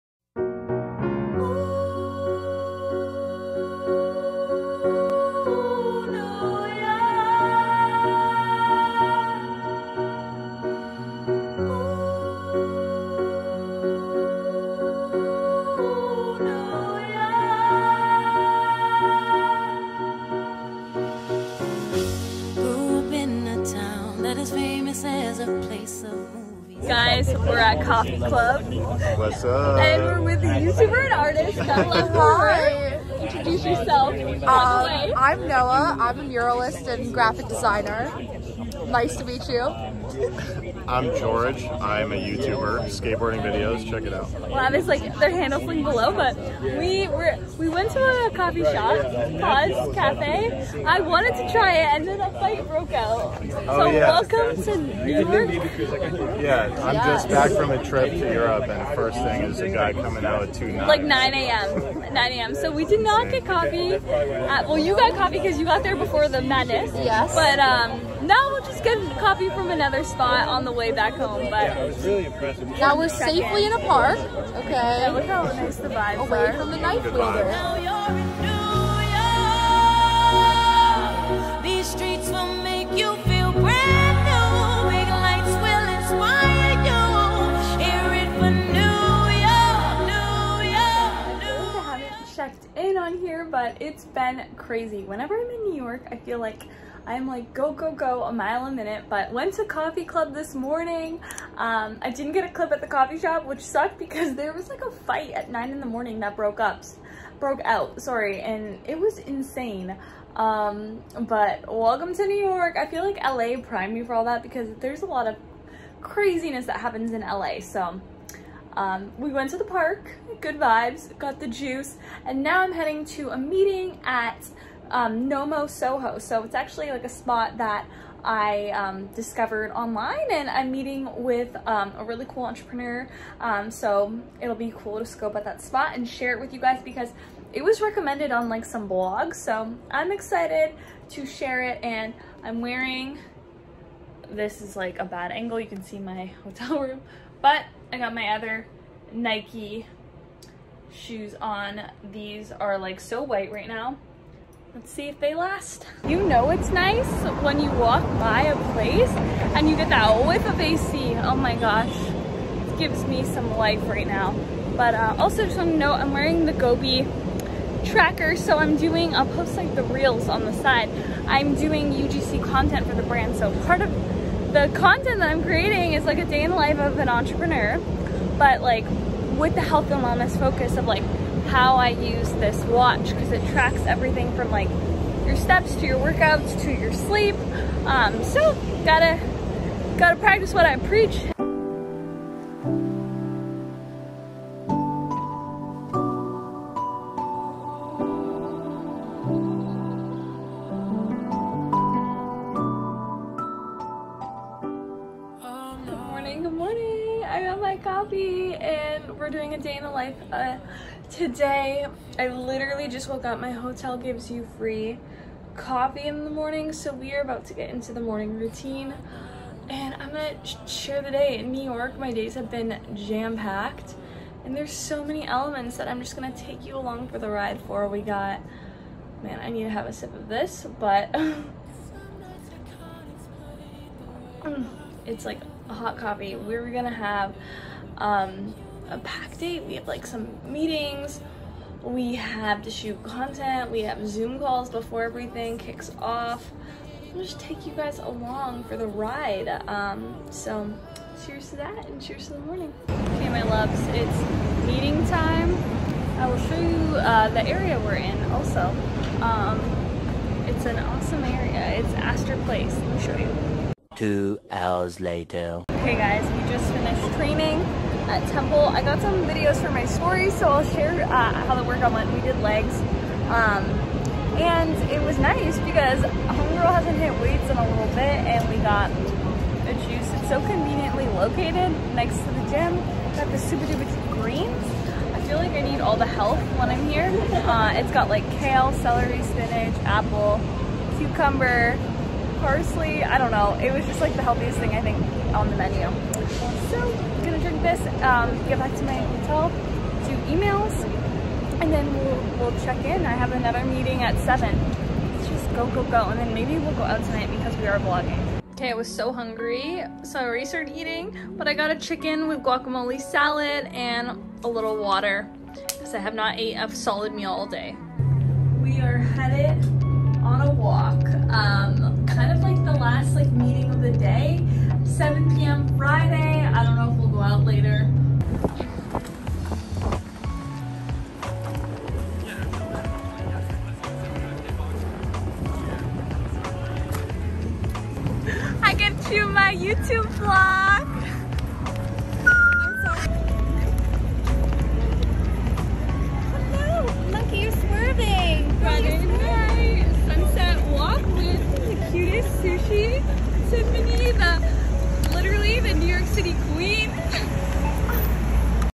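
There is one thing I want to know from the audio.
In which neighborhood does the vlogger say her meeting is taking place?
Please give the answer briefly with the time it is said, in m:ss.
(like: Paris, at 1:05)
Astor Place, at 4:21.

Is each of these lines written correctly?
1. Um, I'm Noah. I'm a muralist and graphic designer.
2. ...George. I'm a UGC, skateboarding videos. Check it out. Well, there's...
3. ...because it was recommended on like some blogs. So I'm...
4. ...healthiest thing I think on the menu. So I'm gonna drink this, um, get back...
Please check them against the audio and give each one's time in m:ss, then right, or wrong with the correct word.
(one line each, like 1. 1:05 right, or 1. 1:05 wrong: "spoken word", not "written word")
1. 0:34 right
2. 0:41 wrong: "YouTuber", not "UGC"
3. 2:16 right
4. 4:54 right.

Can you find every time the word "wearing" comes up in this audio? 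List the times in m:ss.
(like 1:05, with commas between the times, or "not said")
2:22, 2:46.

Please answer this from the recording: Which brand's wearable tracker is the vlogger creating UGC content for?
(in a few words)
Gobi.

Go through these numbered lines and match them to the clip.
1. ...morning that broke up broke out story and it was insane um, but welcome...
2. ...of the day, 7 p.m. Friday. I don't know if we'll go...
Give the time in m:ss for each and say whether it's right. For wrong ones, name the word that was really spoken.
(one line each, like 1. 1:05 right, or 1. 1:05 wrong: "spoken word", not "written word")
1. 1:45 wrong: "sorry", not "story"
2. 5:23 right.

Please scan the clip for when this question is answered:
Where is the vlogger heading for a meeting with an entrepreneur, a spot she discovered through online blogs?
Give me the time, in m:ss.
2:05.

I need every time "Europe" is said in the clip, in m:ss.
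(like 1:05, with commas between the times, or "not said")
0:58.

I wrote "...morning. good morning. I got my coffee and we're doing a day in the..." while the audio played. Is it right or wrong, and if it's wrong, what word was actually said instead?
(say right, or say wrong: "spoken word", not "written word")
right.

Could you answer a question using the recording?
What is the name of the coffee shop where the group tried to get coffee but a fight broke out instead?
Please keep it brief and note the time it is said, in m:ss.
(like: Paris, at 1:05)
Pause Cafe, at 0:49.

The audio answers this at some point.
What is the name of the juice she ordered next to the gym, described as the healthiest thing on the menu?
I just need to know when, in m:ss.
4:43.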